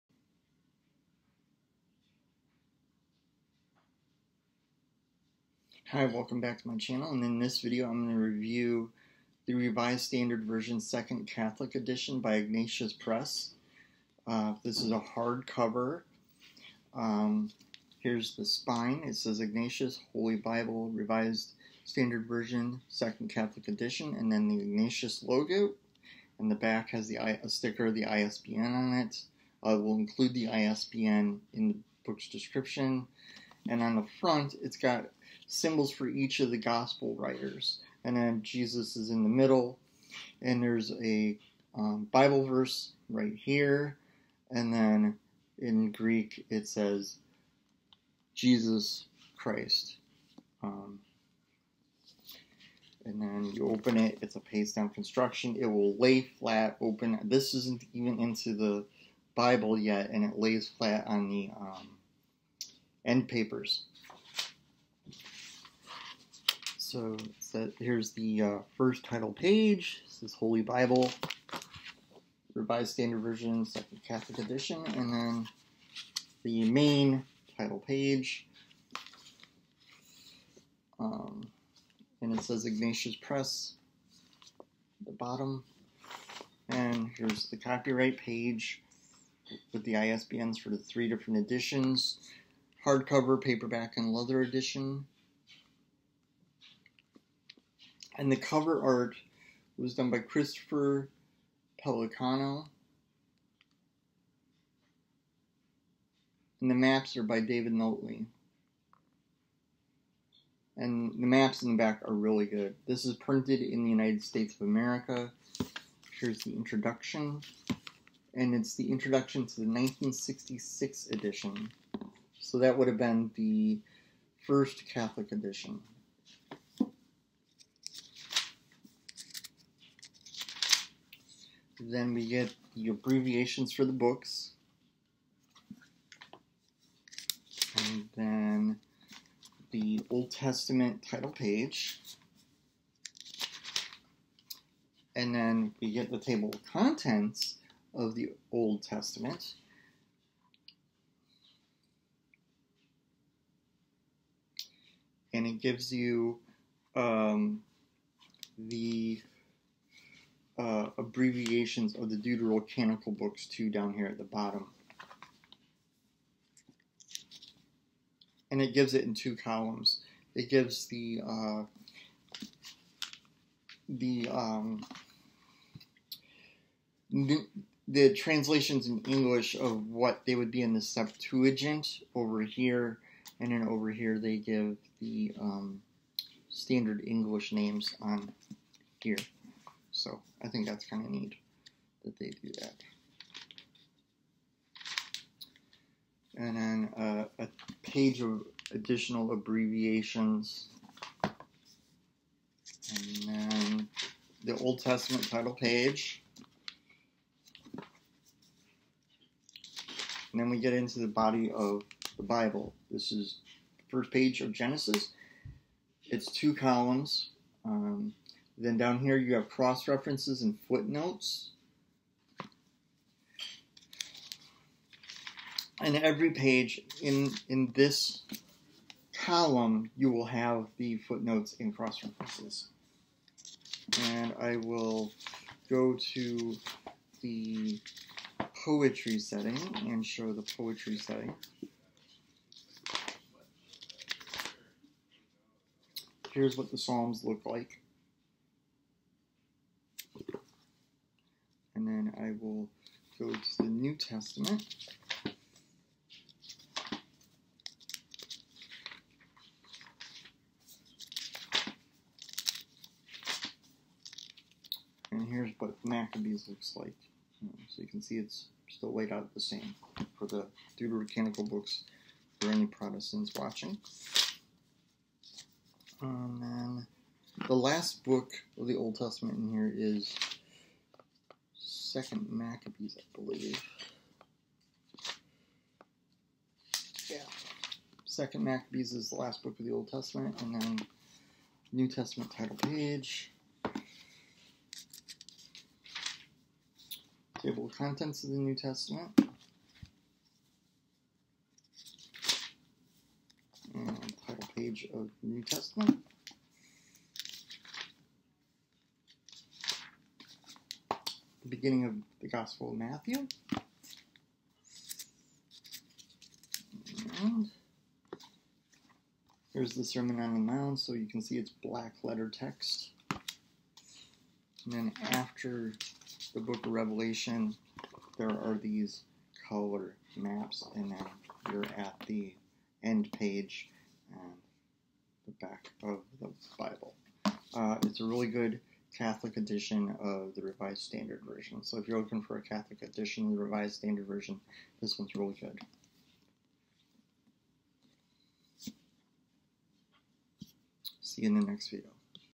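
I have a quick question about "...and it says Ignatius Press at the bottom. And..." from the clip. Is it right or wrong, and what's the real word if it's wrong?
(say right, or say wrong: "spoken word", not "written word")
right.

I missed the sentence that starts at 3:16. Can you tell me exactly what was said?
And then uh, a page of additional abbreviations.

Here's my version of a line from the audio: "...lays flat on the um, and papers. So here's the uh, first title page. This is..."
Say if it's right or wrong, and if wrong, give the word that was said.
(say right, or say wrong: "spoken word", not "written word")
right.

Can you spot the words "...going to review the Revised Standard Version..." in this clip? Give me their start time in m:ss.
0:08.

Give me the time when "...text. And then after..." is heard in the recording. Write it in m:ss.
5:22.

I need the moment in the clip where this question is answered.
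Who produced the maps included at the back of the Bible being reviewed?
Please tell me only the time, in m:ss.
1:47.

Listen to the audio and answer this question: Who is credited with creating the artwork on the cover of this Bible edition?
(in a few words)
Christopher Pelicano.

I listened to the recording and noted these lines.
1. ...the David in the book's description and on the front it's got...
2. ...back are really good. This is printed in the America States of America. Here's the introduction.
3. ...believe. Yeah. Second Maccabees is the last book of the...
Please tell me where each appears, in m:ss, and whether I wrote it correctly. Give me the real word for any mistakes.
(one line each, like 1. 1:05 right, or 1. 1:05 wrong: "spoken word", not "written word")
1. 0:30 wrong: "ISBN", not "David"
2. 1:51 wrong: "United", not "America"
3. 4:43 right.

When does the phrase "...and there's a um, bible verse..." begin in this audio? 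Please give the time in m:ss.
0:40.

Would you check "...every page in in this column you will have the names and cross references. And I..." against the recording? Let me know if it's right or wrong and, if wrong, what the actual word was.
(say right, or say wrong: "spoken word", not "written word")
wrong: "footnotes", not "names".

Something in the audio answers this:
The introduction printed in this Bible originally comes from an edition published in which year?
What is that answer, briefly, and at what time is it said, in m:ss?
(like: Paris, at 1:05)
1966, at 1:59.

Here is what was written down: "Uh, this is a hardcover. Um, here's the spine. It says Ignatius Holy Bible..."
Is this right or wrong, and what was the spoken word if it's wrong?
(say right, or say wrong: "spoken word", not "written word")
right.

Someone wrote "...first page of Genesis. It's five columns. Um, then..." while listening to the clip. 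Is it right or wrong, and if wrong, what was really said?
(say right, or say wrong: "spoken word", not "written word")
wrong: "two", not "five".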